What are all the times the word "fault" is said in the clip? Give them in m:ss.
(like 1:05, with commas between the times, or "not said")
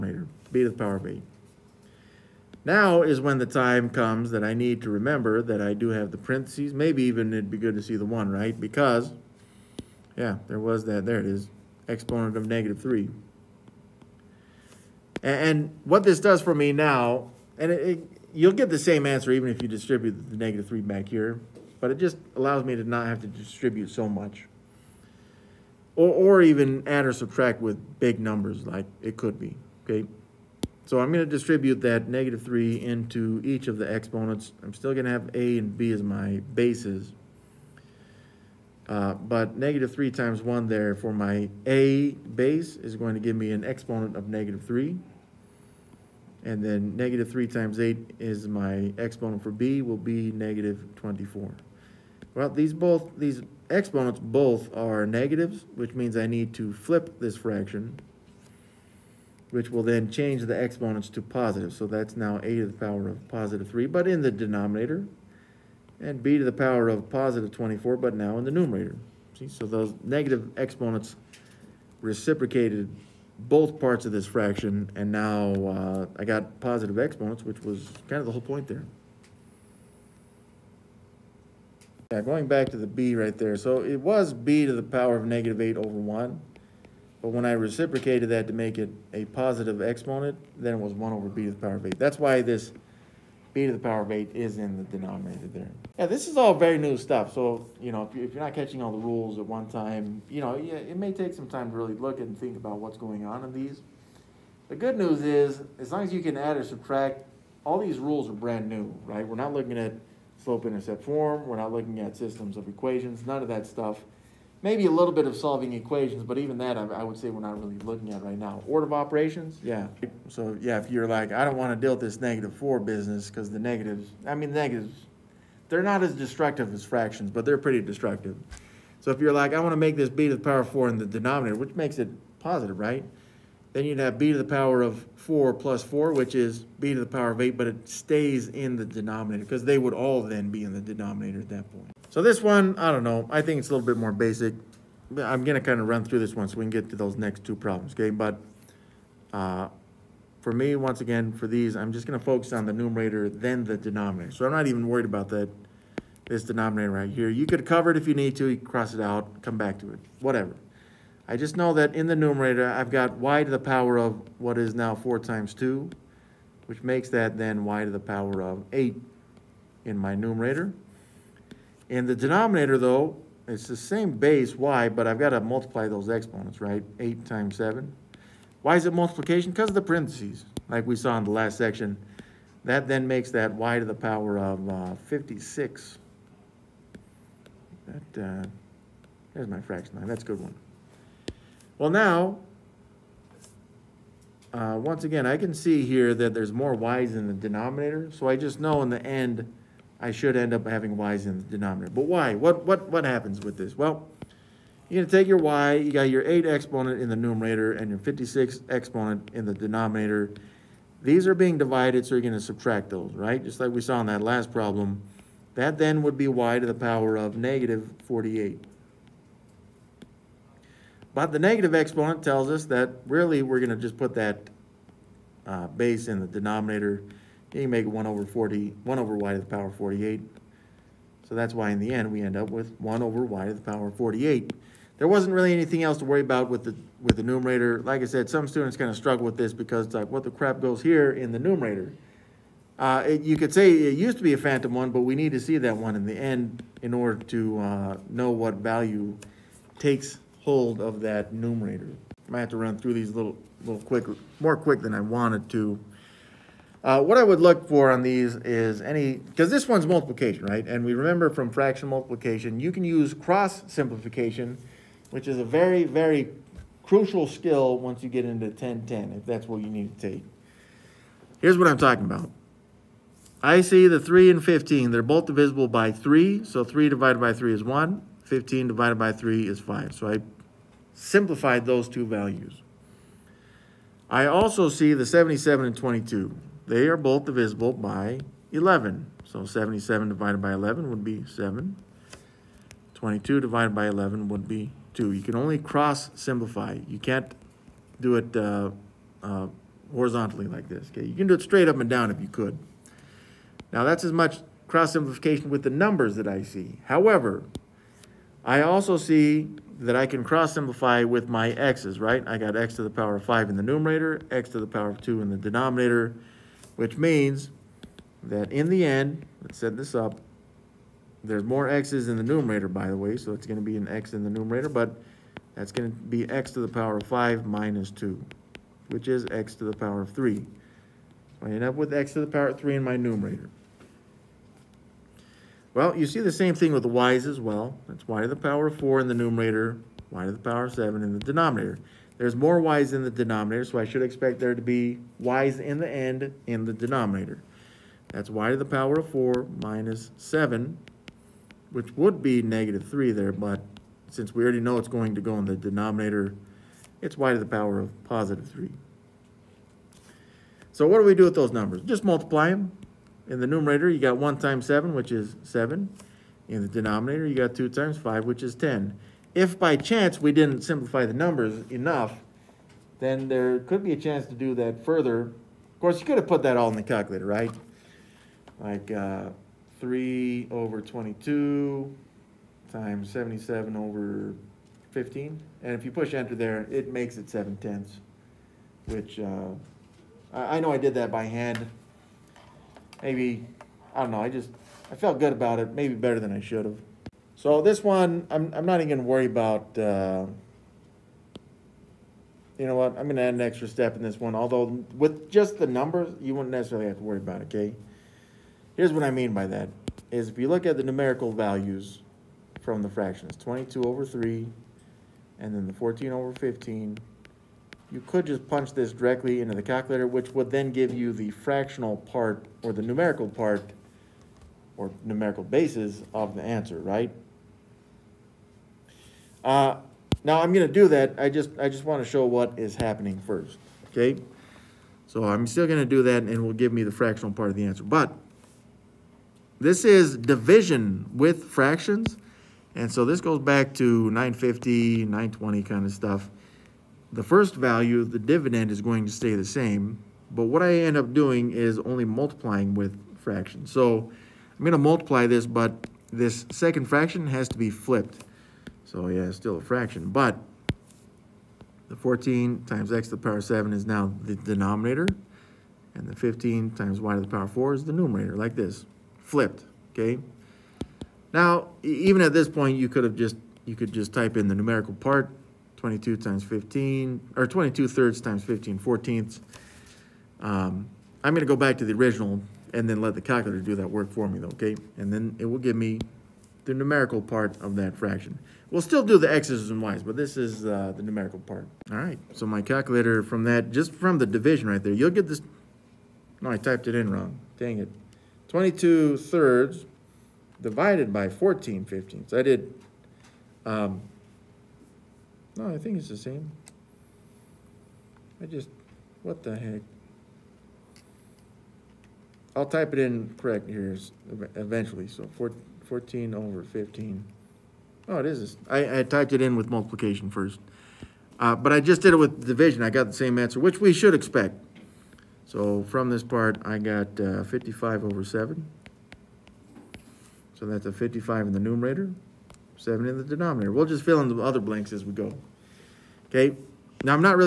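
not said.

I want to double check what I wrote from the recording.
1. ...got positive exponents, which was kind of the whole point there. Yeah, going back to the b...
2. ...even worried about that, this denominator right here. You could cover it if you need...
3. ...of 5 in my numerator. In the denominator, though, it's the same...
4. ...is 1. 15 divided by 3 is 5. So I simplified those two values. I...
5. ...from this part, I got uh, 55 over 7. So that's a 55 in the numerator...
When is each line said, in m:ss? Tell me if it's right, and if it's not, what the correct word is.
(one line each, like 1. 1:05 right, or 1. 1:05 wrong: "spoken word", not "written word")
1. 1:16 right
2. 2:34 right
3. 2:48 wrong: "8", not "5"
4. 4:37 right
5. 8:45 right.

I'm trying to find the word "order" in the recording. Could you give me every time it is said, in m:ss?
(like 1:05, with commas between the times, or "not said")
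1:58, 4:06.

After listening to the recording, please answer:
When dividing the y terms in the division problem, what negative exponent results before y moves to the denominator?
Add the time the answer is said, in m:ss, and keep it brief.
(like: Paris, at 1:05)
-48, at 3:37.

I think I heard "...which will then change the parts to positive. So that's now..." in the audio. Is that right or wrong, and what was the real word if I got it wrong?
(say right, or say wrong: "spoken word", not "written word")
wrong: "exponents", not "parts".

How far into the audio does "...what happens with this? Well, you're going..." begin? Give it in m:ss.
3:22.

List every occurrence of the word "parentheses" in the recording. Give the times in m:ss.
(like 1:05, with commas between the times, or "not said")
0:06, 2:59.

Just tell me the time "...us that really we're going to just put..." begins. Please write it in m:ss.
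3:42.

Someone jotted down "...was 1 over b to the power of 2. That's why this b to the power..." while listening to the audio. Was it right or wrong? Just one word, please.
wrong.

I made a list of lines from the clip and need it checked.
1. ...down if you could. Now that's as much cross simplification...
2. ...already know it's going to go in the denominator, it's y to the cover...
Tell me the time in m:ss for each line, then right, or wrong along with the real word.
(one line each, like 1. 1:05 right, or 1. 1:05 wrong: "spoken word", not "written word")
1. 5:01 right
2. 5:54 wrong: "power", not "cover".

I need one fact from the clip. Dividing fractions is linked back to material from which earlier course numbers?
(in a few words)
950, 920.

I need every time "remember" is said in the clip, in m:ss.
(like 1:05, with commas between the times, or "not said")
0:04, 4:20.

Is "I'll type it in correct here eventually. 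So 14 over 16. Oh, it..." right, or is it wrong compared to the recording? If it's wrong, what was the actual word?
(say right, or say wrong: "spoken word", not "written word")
wrong: "15", not "16".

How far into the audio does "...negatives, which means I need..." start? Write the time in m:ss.
0:55.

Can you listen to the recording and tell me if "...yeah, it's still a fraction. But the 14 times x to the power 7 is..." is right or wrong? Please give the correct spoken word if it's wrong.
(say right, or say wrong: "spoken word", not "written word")
right.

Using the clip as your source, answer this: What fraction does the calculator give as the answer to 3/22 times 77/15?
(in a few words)
7 tenths.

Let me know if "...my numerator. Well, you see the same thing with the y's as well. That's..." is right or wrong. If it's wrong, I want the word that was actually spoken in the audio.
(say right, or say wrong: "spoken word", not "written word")
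right.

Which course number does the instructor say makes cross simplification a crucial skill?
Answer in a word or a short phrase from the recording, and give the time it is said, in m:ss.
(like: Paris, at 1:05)
1010, at 4:28.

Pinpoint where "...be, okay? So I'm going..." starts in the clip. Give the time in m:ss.
0:29.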